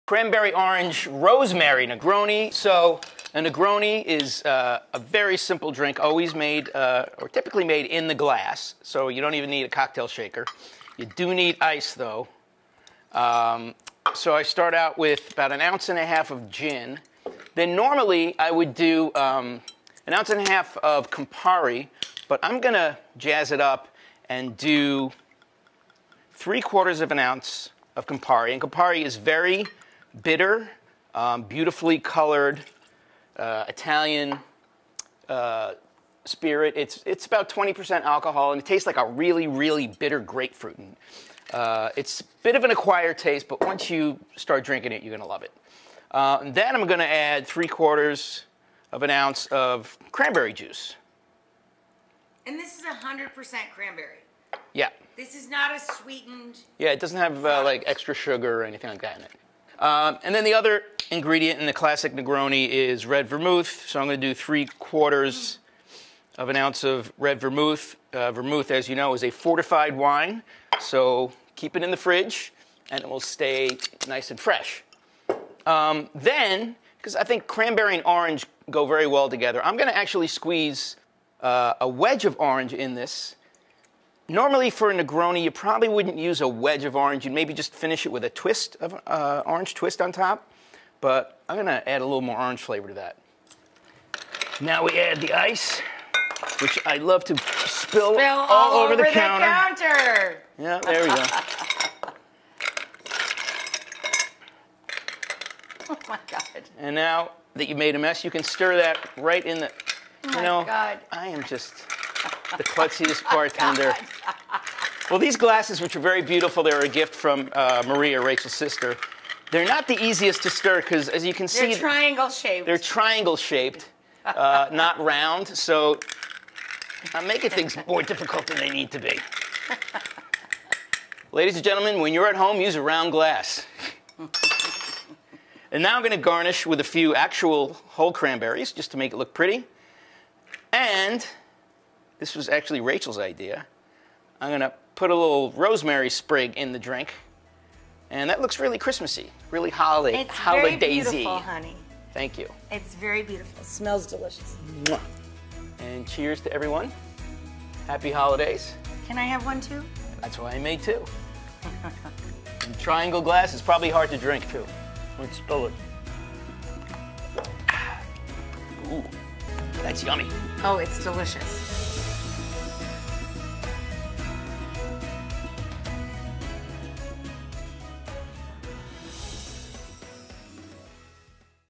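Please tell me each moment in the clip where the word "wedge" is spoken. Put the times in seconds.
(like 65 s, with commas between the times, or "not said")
81 s, 86 s.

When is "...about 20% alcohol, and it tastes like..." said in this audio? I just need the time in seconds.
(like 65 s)
37 s.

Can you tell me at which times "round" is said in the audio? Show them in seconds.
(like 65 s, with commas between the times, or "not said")
124 s, 132 s.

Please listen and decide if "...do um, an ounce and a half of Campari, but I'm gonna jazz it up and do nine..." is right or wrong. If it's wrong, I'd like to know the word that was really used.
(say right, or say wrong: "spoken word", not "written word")
wrong: "three", not "nine".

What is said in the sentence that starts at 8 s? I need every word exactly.
So you don't even need a cocktail shaker.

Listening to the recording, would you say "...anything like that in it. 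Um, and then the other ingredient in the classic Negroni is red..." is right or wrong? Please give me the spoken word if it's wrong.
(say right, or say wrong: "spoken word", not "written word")
right.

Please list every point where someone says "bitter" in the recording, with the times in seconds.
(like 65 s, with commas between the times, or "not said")
30 s, 39 s.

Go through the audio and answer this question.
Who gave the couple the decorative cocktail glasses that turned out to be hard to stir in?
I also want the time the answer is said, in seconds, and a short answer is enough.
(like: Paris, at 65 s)
Maria, at 117 s.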